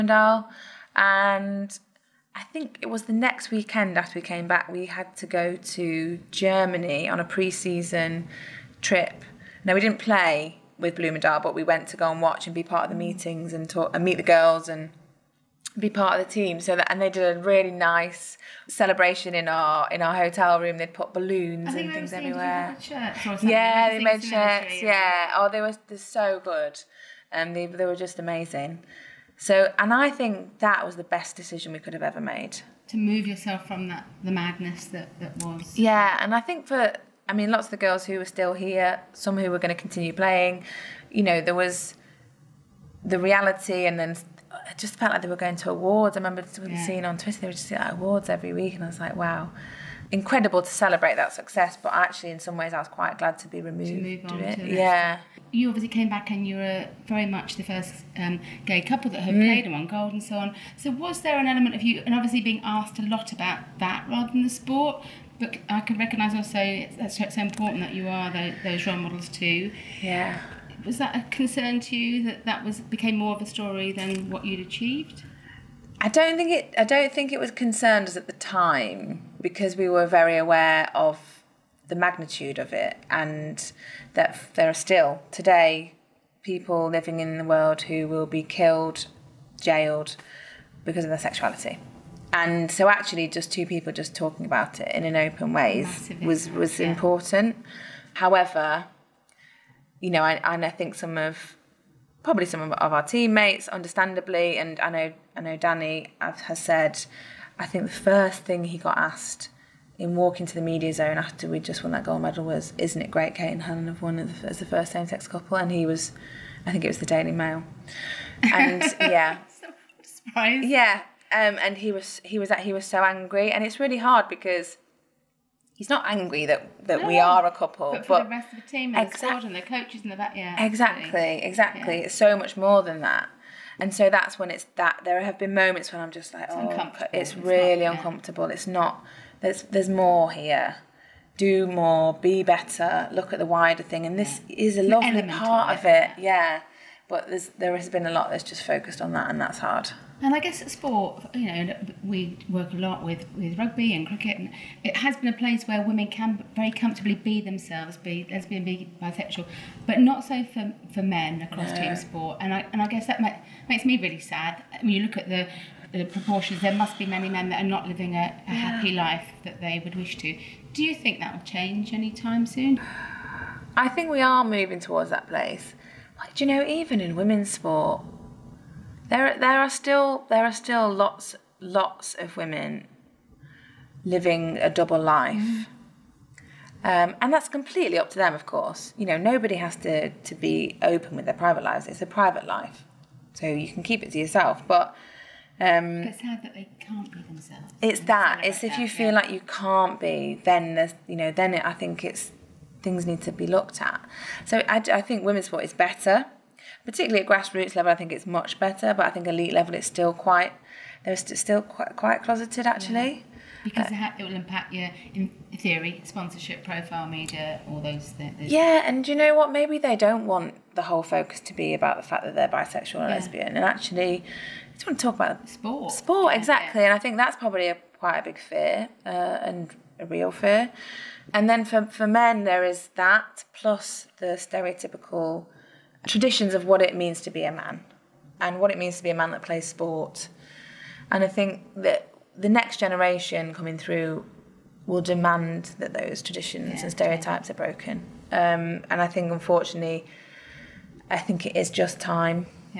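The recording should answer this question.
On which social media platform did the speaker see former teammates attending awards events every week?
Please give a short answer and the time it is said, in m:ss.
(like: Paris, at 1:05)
Twitter, at 0:47.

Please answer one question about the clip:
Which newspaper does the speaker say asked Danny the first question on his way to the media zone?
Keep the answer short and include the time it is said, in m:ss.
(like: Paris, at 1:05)
Daily Mail, at 1:57.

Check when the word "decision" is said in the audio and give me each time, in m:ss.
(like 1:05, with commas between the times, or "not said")
0:31.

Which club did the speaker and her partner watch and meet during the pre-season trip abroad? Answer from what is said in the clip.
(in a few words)
Bloemendaal.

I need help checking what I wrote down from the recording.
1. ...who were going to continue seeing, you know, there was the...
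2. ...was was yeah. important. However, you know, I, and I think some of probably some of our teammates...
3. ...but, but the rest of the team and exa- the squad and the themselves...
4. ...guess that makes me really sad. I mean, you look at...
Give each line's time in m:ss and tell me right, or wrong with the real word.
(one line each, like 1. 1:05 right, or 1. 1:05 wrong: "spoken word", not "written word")
1. 0:39 wrong: "playing", not "seeing"
2. 1:36 right
3. 2:07 wrong: "coaches", not "themselves"
4. 2:42 right.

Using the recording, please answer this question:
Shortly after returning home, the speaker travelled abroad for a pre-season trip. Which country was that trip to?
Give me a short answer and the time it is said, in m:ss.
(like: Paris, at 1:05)
Germany, at 0:06.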